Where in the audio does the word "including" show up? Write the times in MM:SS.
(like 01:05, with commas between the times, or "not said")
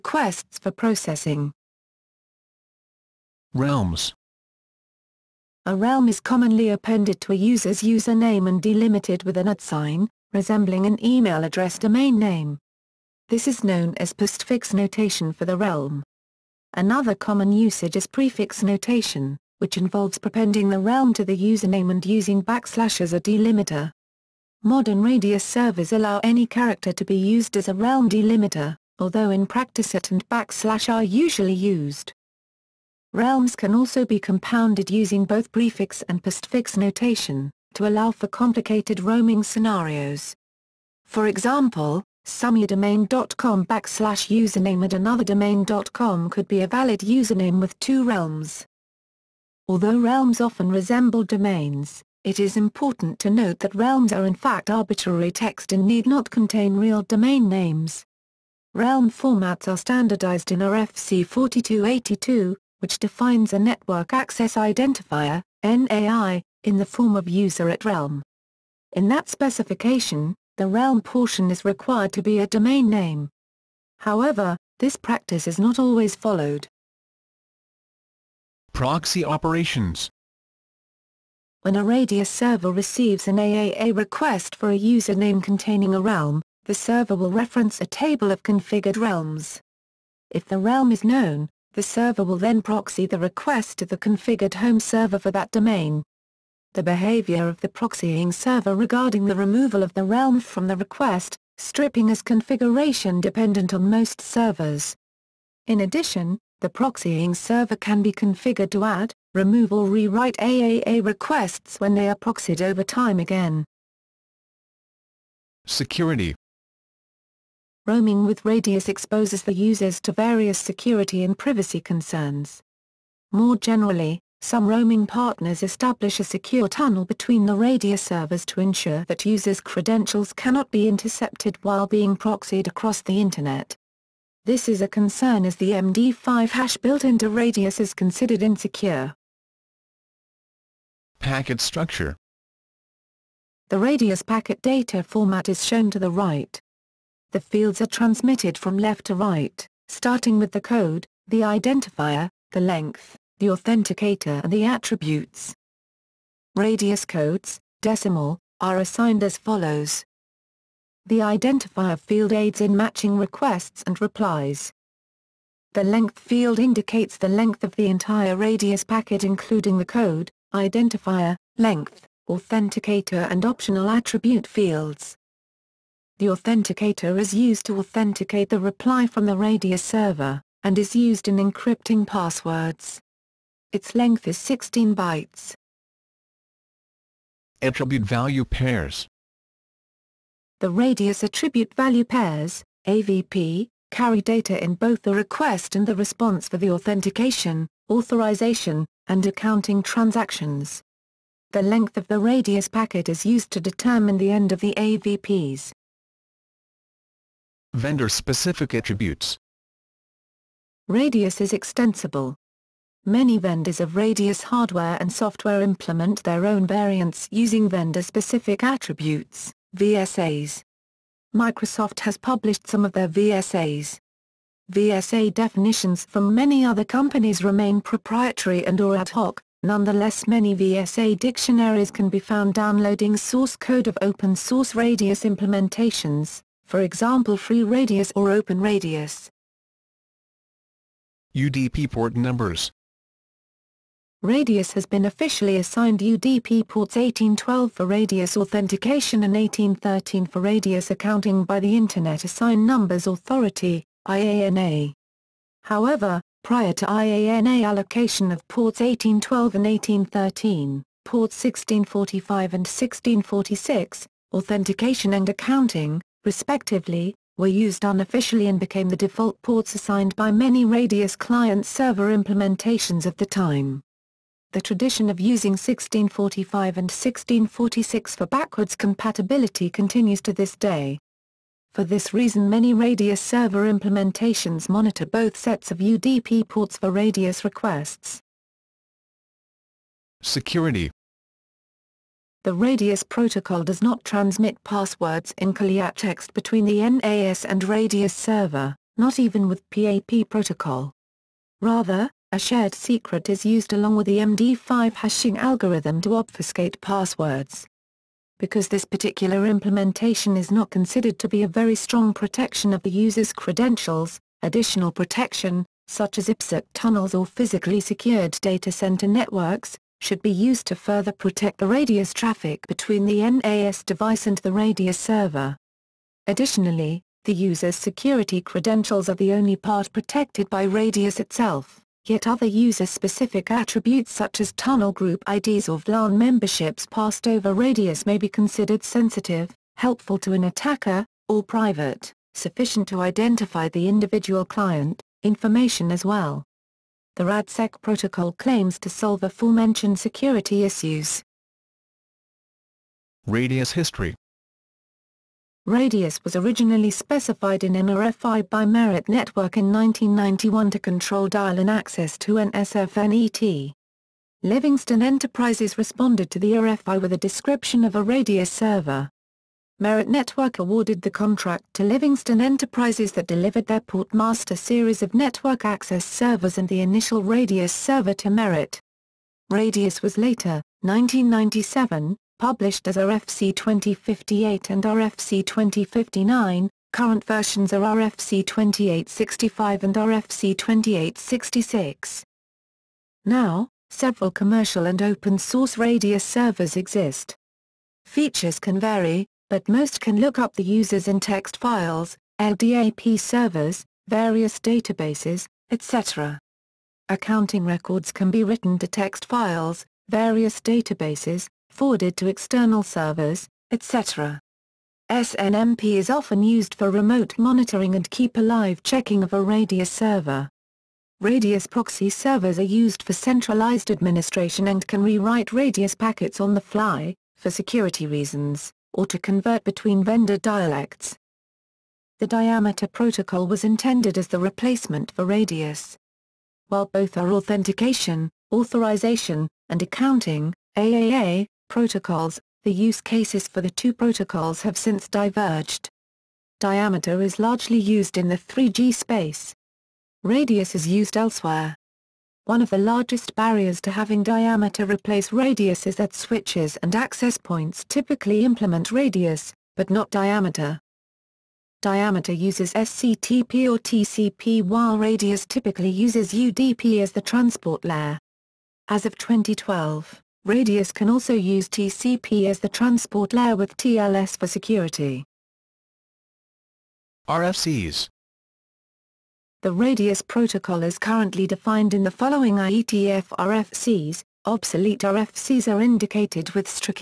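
02:49.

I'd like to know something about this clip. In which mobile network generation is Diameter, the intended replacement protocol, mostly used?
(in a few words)
3G.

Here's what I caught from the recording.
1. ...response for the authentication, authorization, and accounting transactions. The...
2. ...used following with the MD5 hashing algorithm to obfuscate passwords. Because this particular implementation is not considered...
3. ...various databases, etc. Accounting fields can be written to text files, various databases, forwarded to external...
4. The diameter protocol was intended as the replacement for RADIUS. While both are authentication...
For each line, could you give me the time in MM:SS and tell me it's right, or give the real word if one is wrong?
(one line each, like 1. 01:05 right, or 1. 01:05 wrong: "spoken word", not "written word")
1. 03:15 right
2. 05:03 wrong: "along", not "following"
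3. 06:44 wrong: "records", not "fields"
4. 07:12 right.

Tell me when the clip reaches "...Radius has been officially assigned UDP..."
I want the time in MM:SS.
04:04.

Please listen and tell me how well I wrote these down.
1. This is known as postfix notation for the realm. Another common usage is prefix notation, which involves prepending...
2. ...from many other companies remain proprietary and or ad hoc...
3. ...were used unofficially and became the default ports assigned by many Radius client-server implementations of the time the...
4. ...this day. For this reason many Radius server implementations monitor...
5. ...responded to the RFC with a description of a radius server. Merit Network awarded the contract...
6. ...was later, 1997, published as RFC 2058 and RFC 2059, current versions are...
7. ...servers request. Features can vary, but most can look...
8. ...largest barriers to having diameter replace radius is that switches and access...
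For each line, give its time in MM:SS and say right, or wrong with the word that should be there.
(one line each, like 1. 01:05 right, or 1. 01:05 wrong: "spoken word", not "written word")
1. 00:13 right
2. 03:46 right
3. 04:27 right
4. 04:40 right
5. 06:05 wrong: "RFI", not "RFC"
6. 06:20 right
7. 06:36 wrong: "exist", not "request"
8. 07:32 right.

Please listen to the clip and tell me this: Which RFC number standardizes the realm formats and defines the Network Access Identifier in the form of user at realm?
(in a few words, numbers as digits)
4282.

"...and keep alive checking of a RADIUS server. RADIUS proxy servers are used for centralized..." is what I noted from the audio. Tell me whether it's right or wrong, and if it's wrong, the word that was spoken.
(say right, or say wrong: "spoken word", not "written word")
right.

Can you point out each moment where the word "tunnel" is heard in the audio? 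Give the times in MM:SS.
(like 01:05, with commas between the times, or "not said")
02:06, 05:16, 05:34.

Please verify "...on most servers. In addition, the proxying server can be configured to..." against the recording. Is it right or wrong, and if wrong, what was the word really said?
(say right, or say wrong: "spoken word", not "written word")
right.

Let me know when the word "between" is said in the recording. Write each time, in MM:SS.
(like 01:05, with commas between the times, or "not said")
02:07, 04:56, 05:22, 07:09.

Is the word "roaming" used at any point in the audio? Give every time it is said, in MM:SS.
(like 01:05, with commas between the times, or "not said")
00:38, 01:57, 02:04.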